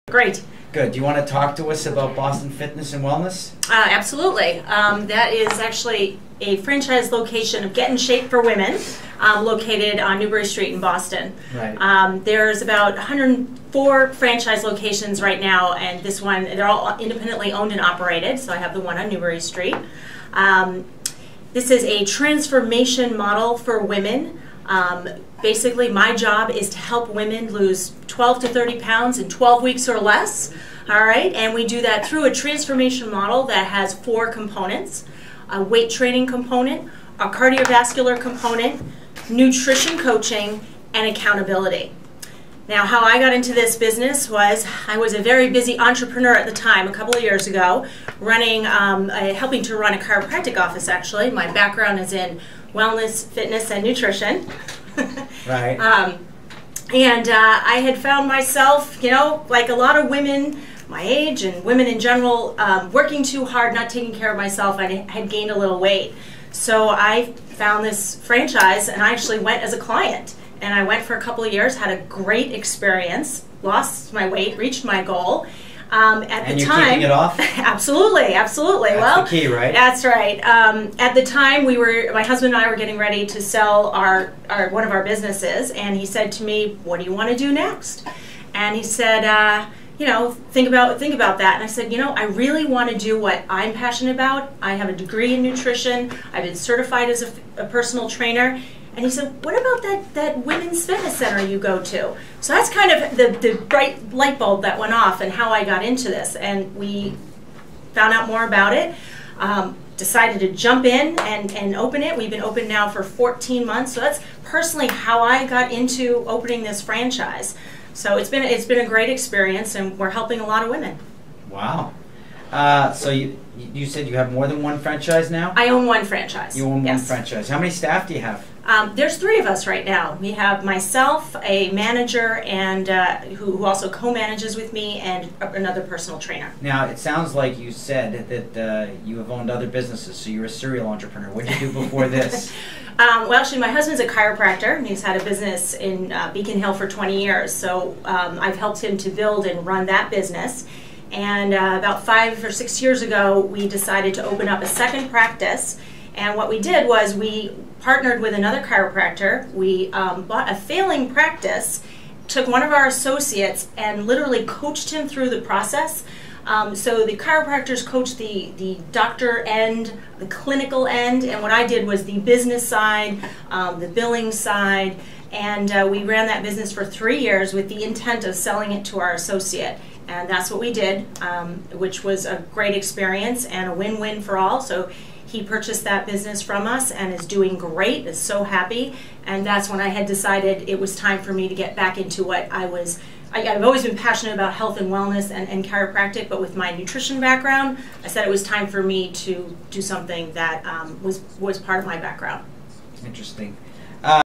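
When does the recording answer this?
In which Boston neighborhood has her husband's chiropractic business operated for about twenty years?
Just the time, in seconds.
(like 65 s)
146 s.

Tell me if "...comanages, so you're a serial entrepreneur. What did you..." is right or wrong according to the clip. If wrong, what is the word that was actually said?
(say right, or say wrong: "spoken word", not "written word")
wrong: "businesses", not "comanages".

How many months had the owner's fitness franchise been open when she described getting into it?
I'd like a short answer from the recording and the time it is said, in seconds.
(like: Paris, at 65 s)
14, at 113 s.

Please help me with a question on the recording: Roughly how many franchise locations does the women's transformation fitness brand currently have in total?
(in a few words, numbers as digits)
104.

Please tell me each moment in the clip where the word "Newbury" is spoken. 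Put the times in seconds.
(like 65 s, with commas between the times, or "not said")
10 s, 19 s.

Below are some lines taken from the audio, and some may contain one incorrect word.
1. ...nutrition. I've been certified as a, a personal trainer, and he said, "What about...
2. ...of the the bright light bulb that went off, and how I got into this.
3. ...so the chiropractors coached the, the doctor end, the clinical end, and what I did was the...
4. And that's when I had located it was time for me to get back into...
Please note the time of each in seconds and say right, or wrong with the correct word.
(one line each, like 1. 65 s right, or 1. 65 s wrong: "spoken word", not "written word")
1. 95 s right
2. 102 s right
3. 166 s right
4. 189 s wrong: "decided", not "located".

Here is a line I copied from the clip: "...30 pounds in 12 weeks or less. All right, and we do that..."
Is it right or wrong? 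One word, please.
right.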